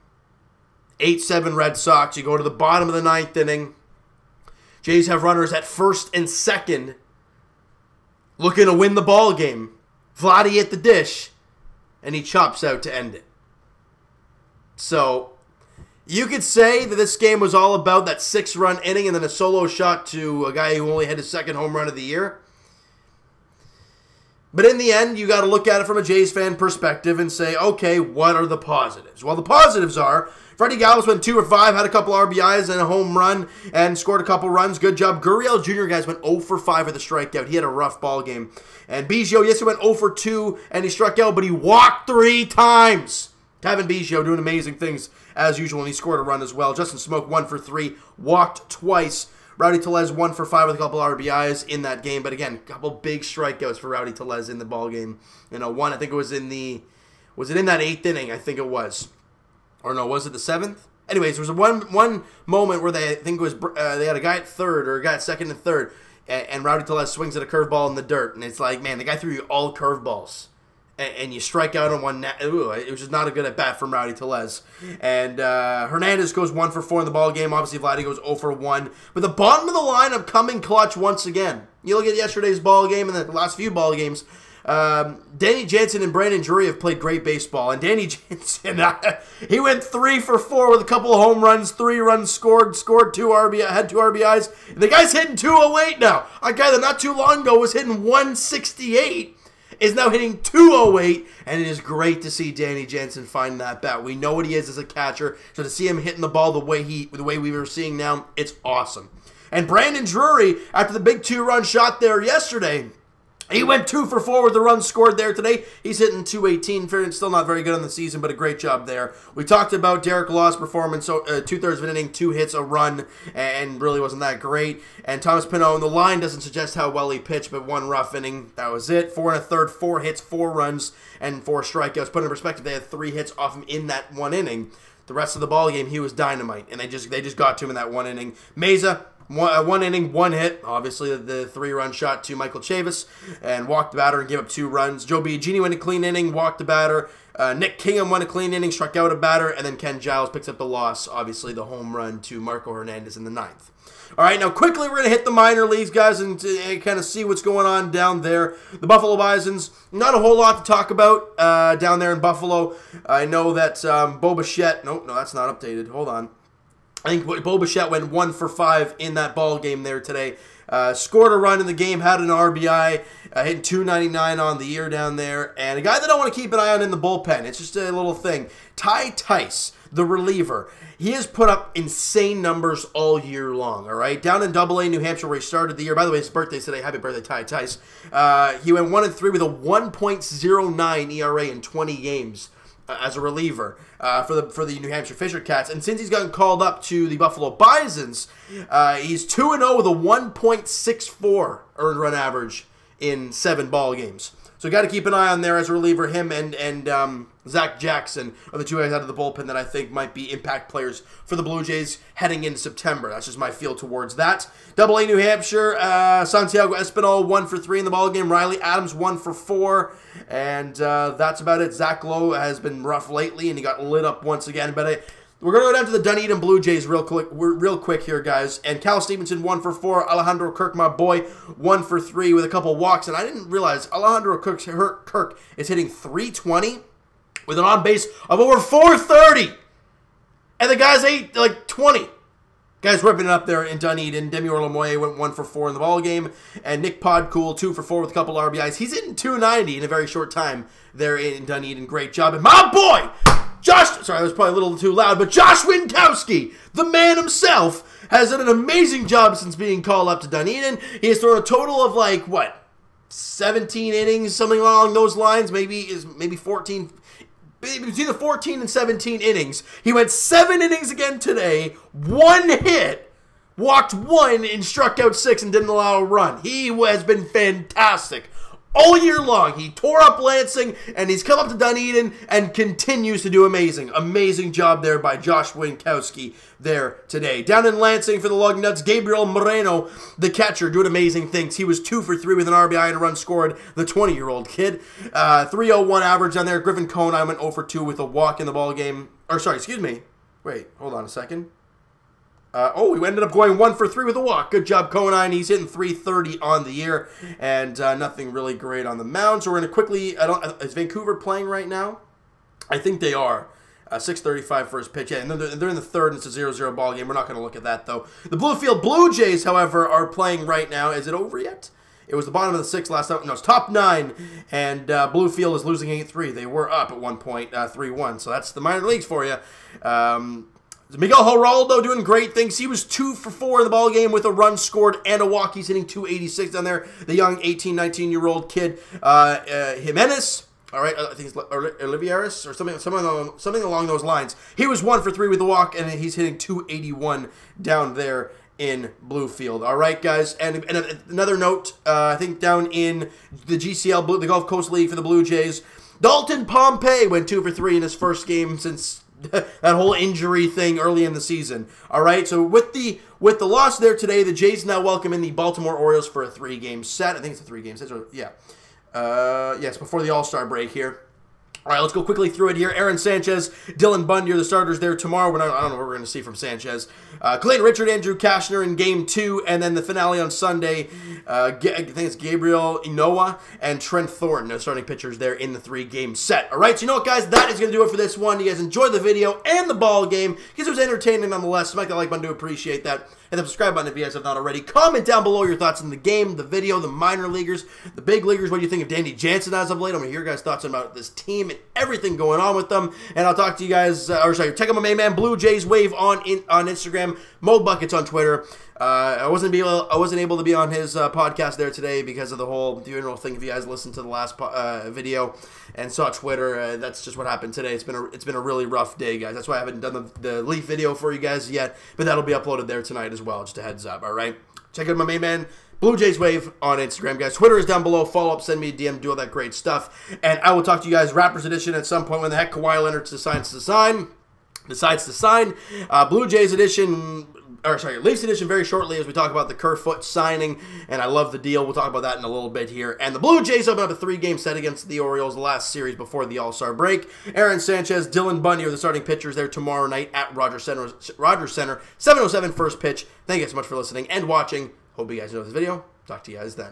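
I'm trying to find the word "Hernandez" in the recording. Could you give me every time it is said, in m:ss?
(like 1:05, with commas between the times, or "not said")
1:15, 2:32.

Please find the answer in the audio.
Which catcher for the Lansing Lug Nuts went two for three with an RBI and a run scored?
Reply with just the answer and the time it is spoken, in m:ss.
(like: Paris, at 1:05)
Gabriel Moreno, at 4:48.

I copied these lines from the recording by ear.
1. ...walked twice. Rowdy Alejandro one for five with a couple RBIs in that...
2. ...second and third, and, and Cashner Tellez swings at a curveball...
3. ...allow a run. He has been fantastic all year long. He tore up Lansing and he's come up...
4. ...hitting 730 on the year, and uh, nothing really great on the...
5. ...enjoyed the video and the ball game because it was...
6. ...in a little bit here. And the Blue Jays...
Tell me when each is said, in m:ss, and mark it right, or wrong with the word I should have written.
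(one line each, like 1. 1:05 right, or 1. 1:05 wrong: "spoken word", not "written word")
1. 0:48 wrong: "Tellez", not "Alejandro"
2. 1:05 wrong: "Rowdy", not "Cashner"
3. 4:35 right
4. 5:05 wrong: "330", not "730"
5. 6:28 right
6. 7:22 right.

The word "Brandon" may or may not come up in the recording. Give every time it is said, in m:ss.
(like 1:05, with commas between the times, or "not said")
1:26, 1:49.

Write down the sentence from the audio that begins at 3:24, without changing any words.
So got to keep an eye on there as a reliever.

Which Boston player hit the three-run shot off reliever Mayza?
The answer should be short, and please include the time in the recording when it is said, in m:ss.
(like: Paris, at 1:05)
Michael Chavis, at 2:22.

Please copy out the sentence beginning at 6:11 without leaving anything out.
All right, let's go quickly through it here.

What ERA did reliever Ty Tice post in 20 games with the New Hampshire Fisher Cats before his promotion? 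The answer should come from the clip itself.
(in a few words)
1.09.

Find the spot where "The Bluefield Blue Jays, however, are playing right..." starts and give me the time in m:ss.
5:18.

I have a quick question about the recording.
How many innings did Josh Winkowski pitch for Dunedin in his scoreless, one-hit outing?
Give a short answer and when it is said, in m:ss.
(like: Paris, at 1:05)
7, at 4:30.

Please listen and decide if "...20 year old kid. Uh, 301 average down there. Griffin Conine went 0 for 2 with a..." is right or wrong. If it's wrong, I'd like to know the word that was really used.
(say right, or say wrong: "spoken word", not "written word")
right.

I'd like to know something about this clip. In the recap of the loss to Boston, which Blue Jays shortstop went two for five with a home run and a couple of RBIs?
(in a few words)
Freddie Galvis.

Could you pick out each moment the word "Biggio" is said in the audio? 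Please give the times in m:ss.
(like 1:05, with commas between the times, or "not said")
0:39, 0:43.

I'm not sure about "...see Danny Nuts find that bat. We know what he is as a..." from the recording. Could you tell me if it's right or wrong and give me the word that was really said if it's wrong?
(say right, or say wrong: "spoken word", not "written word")
wrong: "Jansen", not "Nuts".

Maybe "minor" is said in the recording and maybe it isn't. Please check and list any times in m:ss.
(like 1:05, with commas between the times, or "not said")
2:35, 5:28, 6:36.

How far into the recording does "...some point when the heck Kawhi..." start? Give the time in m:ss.
7:11.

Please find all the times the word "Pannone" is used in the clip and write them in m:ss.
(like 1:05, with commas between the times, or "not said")
2:05.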